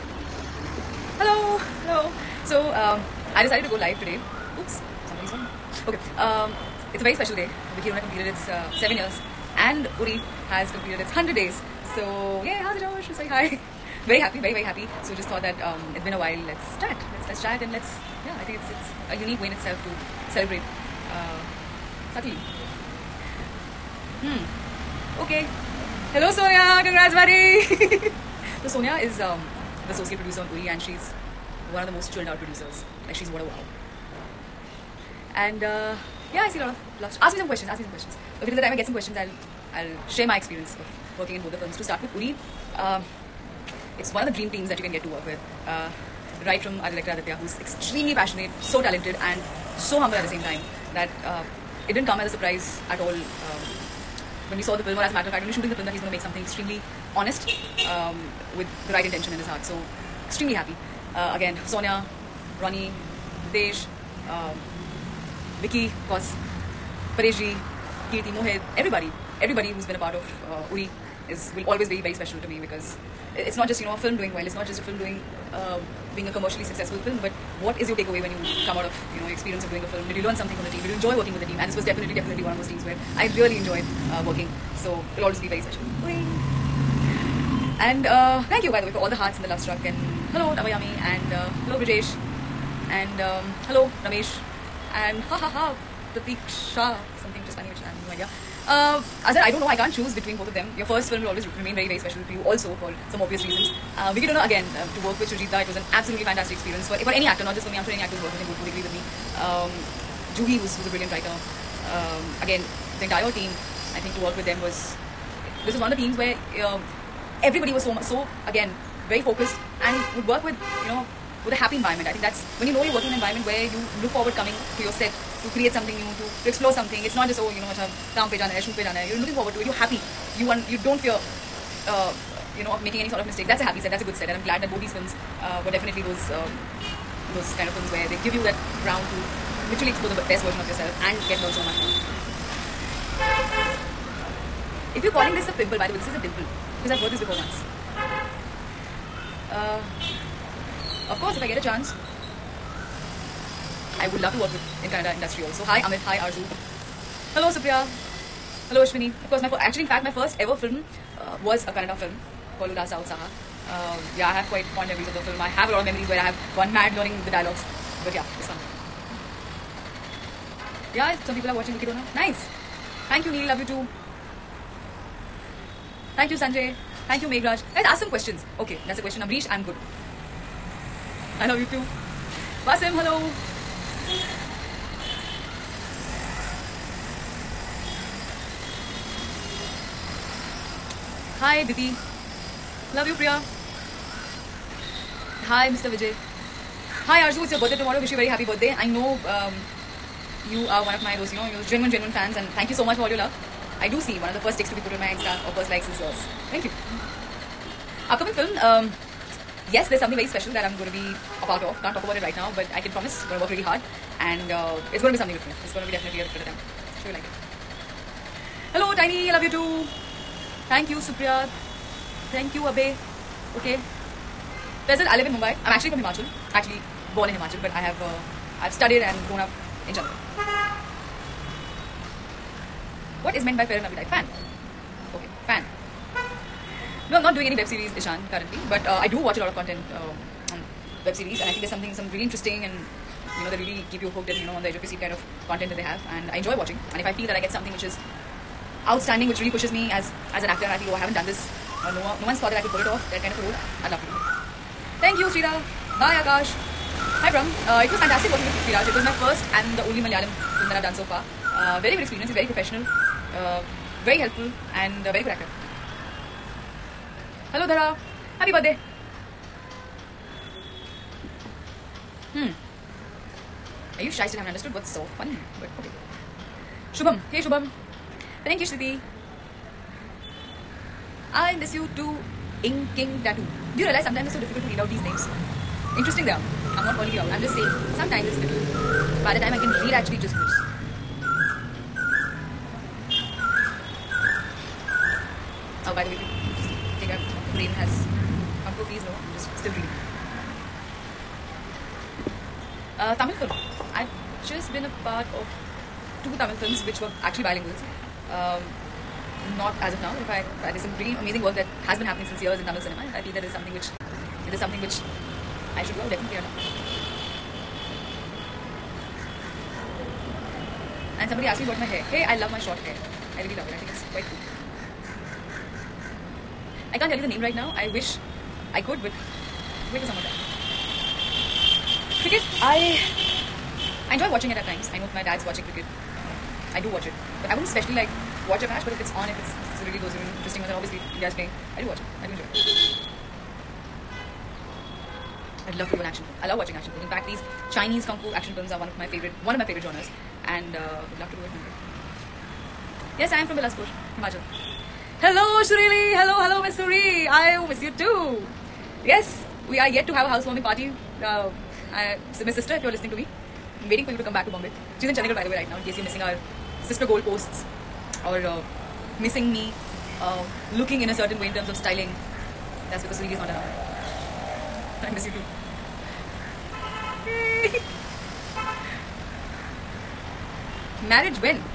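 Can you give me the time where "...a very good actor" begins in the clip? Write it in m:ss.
4:25.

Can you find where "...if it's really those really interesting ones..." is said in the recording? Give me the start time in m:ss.
5:39.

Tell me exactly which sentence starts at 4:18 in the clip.
It was my first and the only Malayalam film that I've done so far.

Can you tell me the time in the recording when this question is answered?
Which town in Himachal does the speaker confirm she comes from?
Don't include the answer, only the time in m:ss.
5:53.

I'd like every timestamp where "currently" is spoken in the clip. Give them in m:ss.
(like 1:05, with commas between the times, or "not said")
3:58.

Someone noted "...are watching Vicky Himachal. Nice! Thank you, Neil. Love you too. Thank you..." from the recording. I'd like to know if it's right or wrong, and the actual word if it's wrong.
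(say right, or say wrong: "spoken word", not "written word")
wrong: "Donor", not "Himachal".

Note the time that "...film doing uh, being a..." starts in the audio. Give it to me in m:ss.
1:14.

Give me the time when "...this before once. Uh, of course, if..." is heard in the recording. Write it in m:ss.
2:27.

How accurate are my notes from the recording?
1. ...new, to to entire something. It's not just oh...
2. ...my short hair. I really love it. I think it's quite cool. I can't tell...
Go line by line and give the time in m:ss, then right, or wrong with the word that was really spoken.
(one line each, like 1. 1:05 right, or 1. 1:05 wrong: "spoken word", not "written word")
1. 2:06 wrong: "explore", not "entire"
2. 5:22 right.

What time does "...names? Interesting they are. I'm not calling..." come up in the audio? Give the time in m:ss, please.
4:45.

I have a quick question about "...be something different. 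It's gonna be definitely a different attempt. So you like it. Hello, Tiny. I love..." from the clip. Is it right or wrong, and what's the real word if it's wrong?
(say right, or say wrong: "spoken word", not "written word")
right.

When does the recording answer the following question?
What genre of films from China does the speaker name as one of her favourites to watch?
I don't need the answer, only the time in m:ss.
5:47.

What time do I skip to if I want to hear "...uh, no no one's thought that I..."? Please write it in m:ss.
4:11.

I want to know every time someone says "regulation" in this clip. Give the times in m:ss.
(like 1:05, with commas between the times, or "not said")
not said.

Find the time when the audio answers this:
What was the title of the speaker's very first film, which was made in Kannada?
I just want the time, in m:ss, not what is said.
2:42.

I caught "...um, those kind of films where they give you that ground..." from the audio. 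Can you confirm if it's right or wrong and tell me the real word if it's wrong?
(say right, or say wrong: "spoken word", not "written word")
right.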